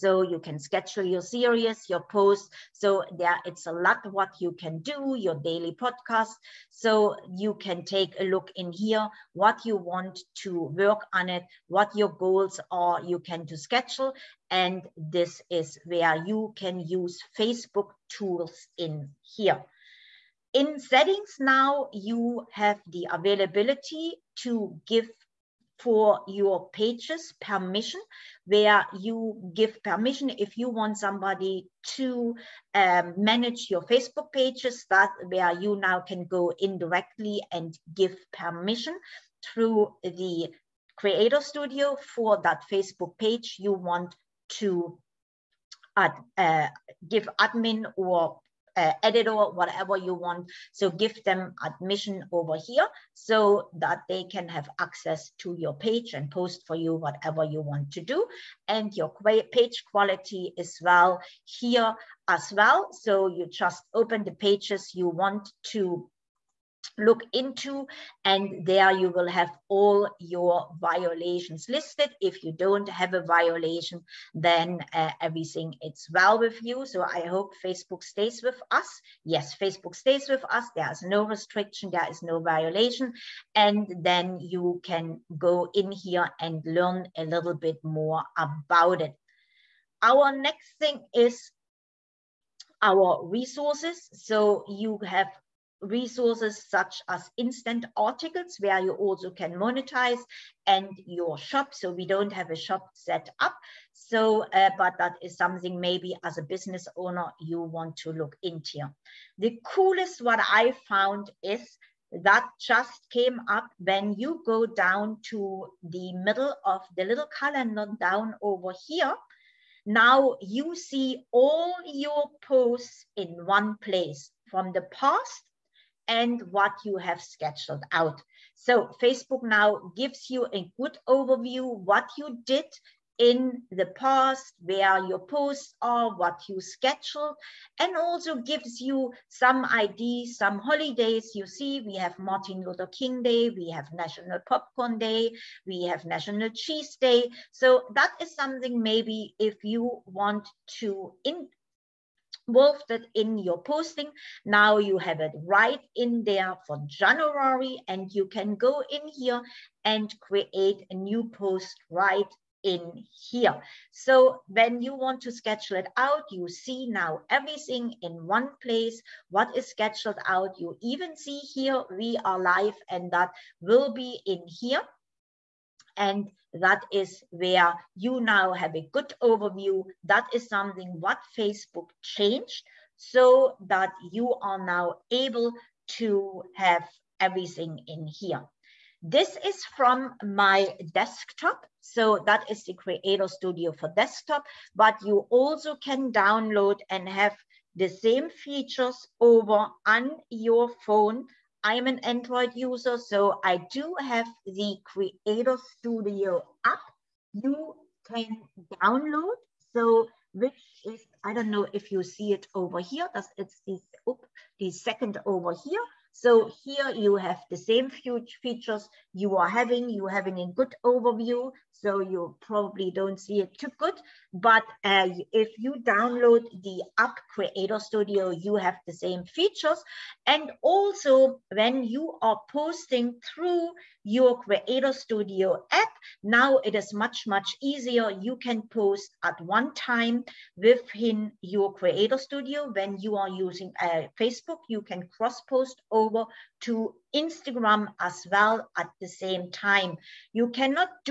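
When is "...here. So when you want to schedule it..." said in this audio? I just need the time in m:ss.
2:43.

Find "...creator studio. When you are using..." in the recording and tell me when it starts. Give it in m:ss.
4:01.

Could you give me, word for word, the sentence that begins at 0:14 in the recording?
And this is where you can use Facebook tools in here.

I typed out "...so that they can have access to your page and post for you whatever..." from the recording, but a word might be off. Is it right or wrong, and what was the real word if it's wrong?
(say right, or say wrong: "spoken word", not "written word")
right.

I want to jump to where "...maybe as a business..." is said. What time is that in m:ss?
1:45.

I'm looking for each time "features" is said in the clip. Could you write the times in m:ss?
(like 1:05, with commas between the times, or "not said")
3:18, 3:37, 3:49.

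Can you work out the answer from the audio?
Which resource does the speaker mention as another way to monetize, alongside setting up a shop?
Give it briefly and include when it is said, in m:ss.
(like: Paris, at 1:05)
Instant articles, at 1:37.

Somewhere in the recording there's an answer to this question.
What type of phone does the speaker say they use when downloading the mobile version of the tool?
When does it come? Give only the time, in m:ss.
3:21.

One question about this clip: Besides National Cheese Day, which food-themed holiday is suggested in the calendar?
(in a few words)
National Popcorn Day.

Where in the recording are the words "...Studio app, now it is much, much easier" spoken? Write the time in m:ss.
3:54.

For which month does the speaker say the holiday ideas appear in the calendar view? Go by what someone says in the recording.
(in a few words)
January.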